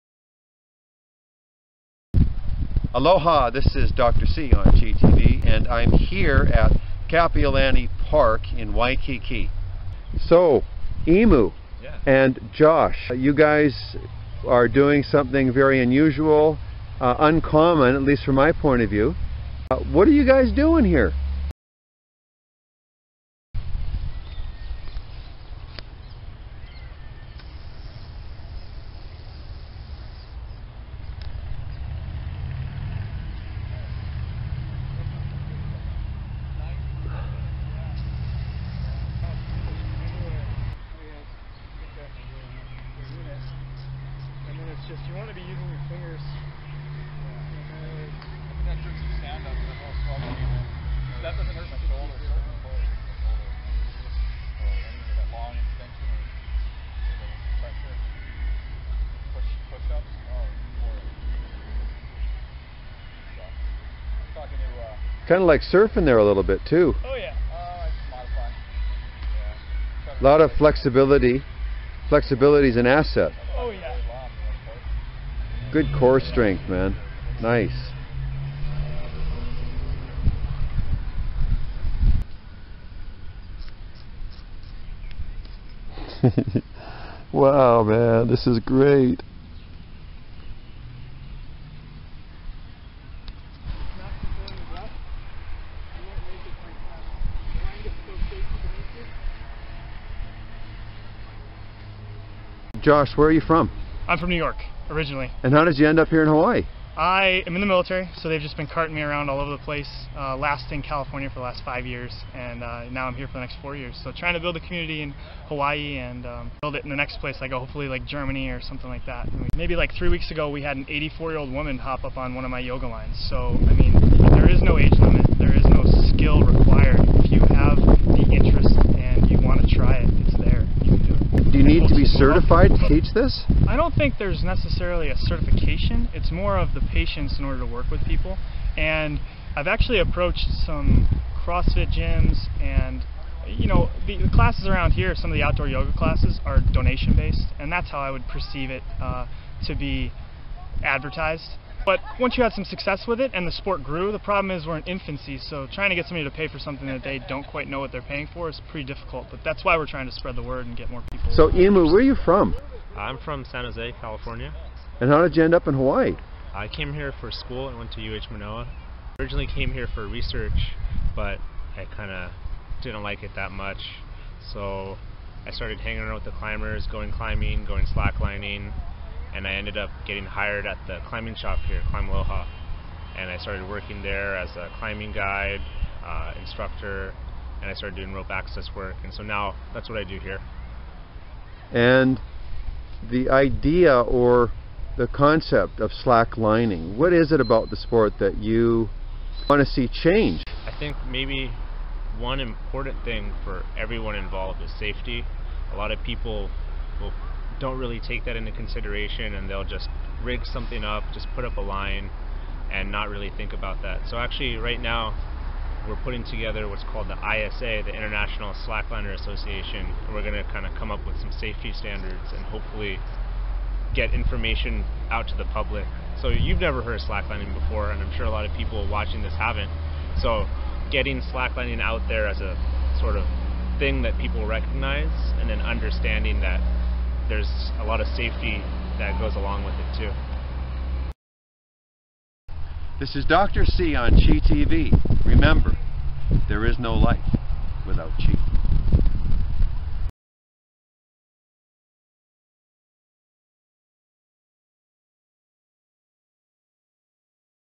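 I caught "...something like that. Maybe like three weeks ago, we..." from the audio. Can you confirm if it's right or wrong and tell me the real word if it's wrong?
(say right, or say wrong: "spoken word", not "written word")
right.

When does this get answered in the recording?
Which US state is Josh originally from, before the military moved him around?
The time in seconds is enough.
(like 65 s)
104 s.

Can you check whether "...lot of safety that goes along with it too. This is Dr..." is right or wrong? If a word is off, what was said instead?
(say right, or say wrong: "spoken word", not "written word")
right.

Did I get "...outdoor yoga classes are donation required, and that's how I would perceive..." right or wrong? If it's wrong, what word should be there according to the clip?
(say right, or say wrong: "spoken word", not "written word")
wrong: "based", not "required".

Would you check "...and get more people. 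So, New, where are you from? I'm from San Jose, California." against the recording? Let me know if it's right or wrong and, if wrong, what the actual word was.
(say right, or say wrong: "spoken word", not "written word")
wrong: "Emu", not "New".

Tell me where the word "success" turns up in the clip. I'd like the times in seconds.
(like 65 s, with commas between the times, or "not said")
152 s.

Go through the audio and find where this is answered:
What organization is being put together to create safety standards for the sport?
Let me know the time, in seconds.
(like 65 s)
217 s.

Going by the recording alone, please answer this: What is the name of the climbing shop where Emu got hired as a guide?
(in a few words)
Climb Aloha.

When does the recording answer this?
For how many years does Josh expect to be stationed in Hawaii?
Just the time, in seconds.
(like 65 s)
113 s.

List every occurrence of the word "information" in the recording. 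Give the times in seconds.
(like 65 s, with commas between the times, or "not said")
224 s.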